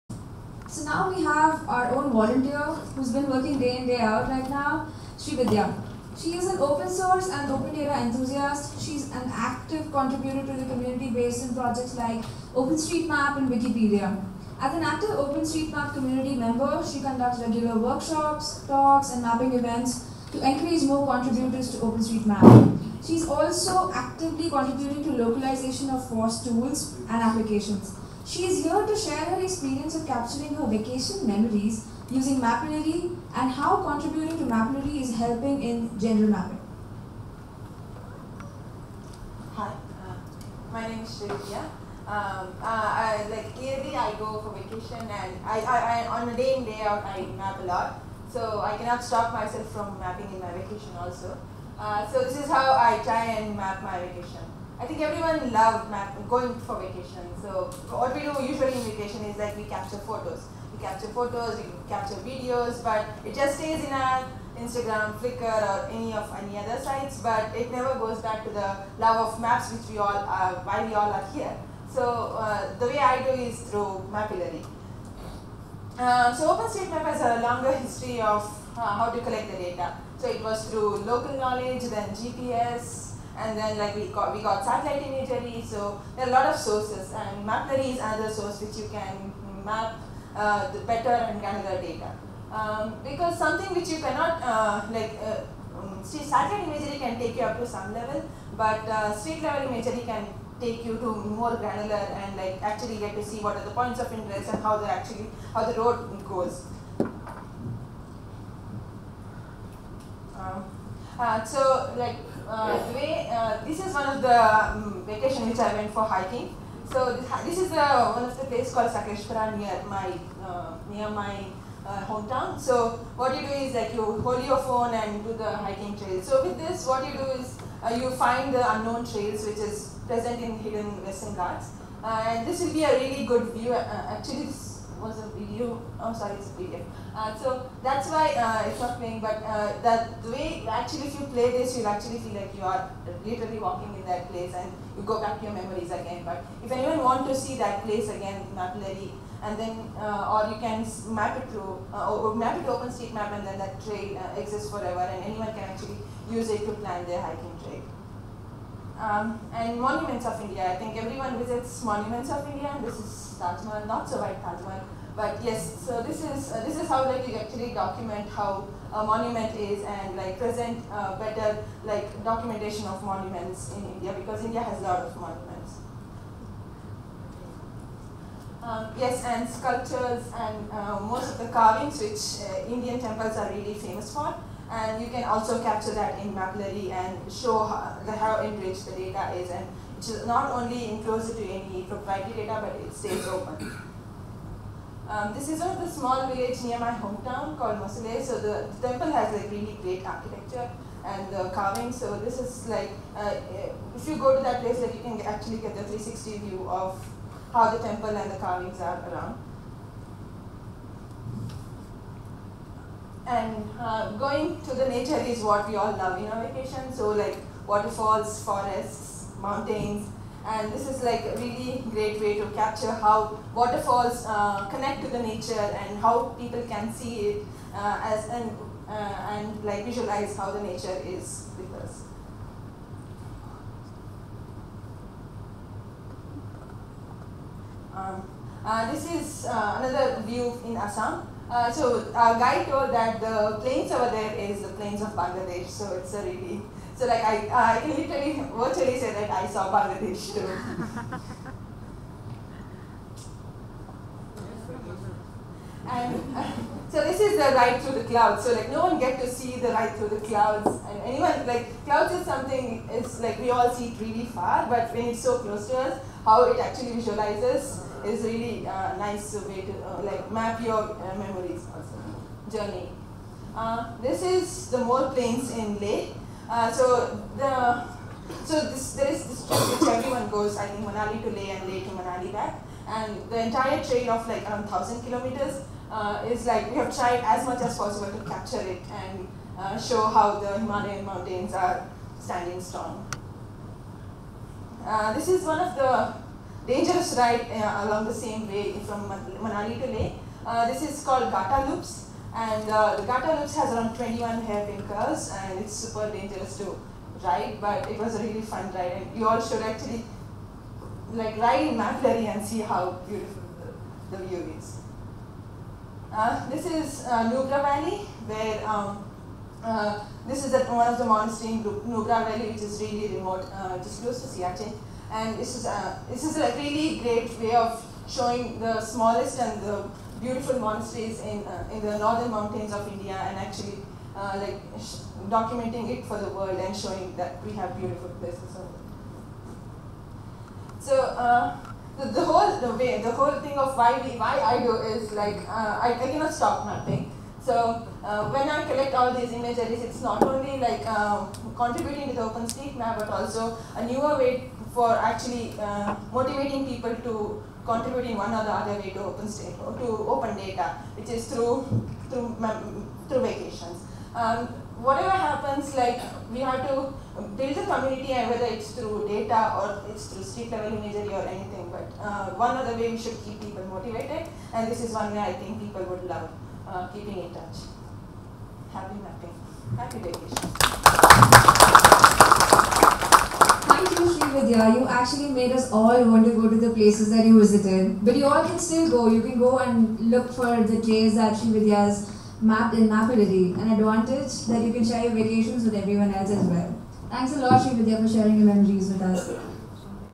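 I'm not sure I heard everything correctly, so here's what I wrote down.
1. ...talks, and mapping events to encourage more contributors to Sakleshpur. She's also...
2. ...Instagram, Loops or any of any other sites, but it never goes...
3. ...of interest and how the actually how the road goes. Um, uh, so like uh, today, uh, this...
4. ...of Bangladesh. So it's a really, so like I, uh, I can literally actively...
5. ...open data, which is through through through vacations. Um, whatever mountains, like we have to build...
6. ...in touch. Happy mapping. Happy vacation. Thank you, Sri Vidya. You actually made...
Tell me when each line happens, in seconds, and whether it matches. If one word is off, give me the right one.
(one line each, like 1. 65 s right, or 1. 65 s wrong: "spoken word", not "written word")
1. 18 s wrong: "OpenStreetMap", not "Sakleshpur"
2. 64 s wrong: "Flickr", not "Loops"
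3. 103 s right
4. 245 s wrong: "virtually", not "actively"
5. 360 s wrong: "happens", not "mountains"
6. 377 s right.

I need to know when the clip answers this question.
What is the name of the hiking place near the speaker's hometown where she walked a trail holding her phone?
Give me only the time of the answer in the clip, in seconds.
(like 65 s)
118 s.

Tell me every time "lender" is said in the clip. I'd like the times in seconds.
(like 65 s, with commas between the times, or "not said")
not said.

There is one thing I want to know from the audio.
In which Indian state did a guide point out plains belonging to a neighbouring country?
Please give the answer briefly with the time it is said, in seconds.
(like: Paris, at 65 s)
Assam, at 240 s.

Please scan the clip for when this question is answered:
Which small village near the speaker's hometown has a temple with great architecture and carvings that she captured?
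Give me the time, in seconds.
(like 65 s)
197 s.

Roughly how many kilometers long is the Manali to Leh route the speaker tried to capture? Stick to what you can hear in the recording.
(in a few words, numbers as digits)
1000.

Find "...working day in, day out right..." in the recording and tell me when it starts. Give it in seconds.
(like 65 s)
3 s.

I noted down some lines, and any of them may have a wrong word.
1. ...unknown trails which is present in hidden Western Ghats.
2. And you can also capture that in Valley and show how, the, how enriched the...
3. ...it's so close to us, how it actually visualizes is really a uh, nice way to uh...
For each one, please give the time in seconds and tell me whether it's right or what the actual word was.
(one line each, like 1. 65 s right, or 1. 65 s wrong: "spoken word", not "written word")
1. 128 s right
2. 184 s wrong: "Mapillary", not "Valley"
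3. 265 s right.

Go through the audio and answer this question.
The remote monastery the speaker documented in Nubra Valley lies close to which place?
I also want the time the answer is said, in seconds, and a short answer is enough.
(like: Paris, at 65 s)
Siachen, at 324 s.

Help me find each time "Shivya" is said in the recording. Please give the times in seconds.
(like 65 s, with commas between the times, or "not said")
41 s.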